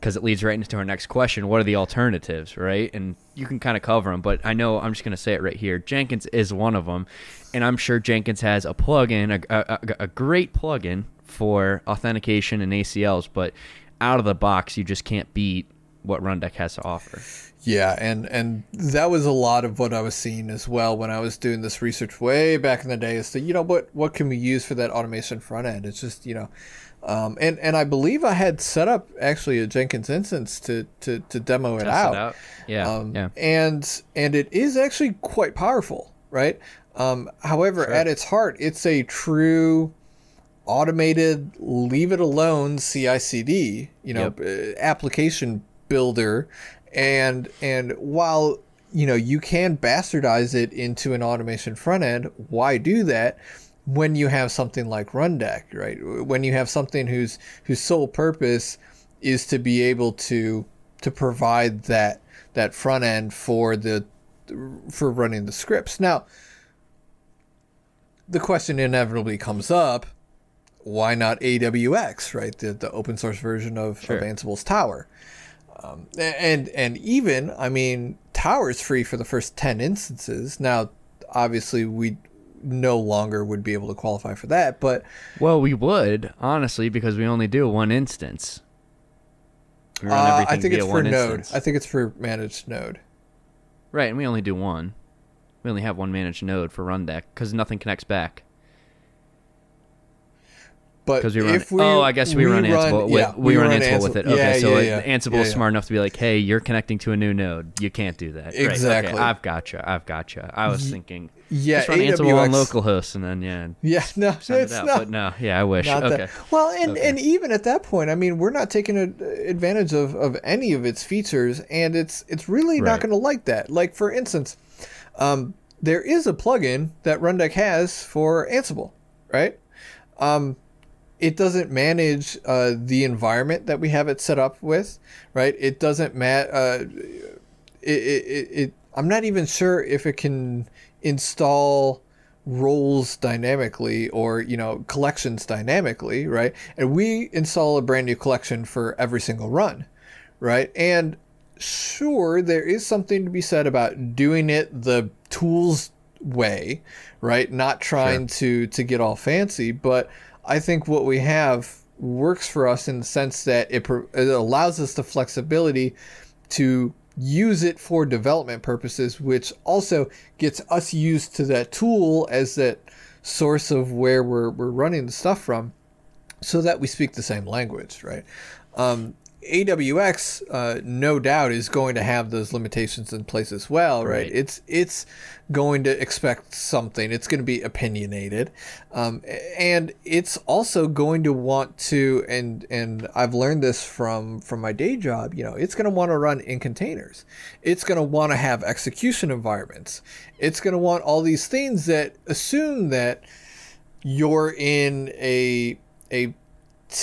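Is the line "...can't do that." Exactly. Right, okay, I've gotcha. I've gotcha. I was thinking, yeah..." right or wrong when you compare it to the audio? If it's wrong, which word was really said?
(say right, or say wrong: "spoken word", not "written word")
right.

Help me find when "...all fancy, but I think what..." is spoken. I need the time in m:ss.
2:38.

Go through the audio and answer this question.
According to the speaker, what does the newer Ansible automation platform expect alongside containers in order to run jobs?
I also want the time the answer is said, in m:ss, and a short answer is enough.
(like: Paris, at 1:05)
execution environments, at 3:18.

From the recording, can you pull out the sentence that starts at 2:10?
Um, it doesn't manage uh, the environment that we have it set up with, right?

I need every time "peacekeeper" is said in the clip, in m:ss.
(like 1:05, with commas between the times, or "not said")
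not said.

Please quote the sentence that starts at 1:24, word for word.
But well, we would honestly because we only do one instance.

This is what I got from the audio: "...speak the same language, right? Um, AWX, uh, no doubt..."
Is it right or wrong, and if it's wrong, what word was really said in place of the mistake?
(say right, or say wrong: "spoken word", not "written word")
right.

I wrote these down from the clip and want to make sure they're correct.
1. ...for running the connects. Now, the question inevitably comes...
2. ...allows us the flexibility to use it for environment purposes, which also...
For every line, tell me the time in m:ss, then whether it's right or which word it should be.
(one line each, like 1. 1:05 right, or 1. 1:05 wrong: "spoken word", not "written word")
1. 1:04 wrong: "scripts", not "connects"
2. 2:44 wrong: "development", not "environment".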